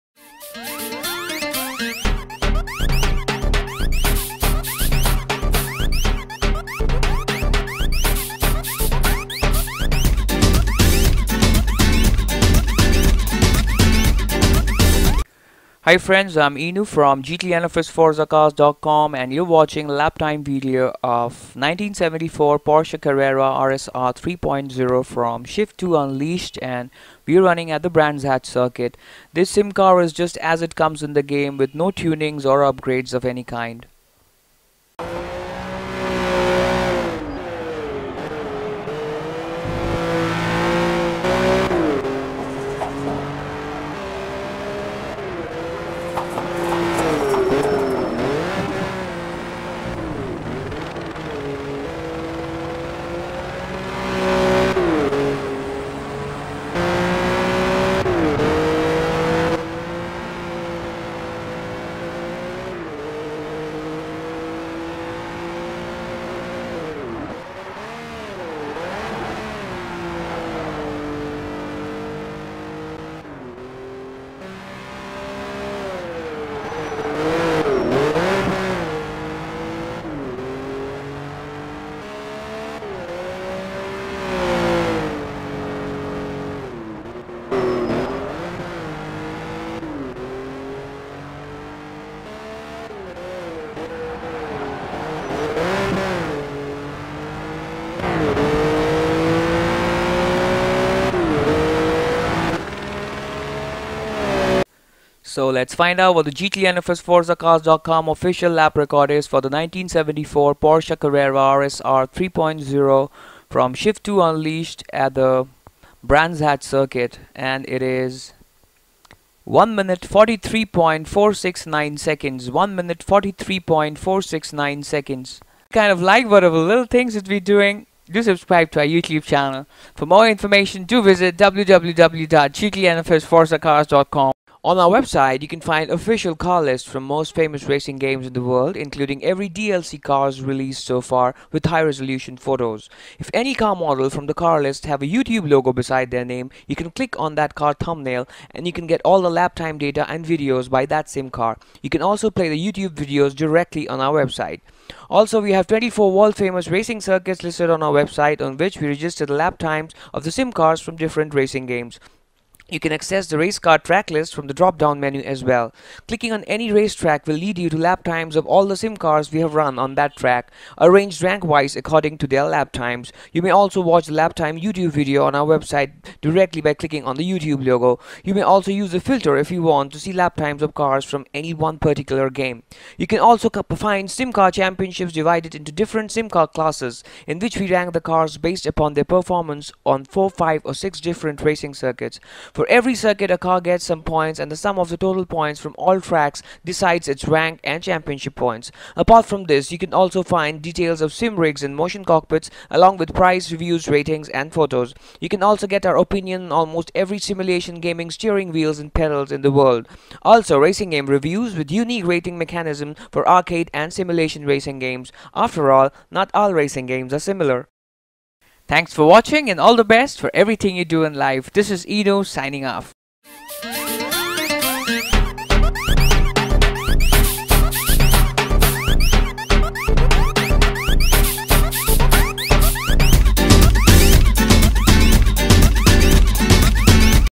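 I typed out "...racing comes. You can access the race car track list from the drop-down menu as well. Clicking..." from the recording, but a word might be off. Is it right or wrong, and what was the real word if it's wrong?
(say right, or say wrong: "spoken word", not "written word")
wrong: "games", not "comes".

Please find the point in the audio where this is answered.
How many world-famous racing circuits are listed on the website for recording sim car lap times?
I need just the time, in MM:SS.
02:35.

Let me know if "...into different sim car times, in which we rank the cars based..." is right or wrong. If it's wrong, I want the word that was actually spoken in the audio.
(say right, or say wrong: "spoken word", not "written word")
wrong: "classes", not "times".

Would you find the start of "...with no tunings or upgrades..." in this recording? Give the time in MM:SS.
00:31.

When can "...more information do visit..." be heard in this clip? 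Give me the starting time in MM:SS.
02:10.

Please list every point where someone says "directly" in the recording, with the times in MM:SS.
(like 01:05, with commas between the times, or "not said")
02:33, 02:56.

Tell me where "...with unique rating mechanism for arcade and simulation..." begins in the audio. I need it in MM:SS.
03:31.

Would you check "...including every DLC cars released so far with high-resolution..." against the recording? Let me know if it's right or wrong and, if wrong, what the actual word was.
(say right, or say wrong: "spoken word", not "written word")
right.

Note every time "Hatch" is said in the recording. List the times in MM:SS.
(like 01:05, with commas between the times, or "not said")
00:28, 01:56.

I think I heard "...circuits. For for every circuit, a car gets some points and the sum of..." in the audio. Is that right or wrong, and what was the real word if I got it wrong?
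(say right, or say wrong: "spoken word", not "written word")
right.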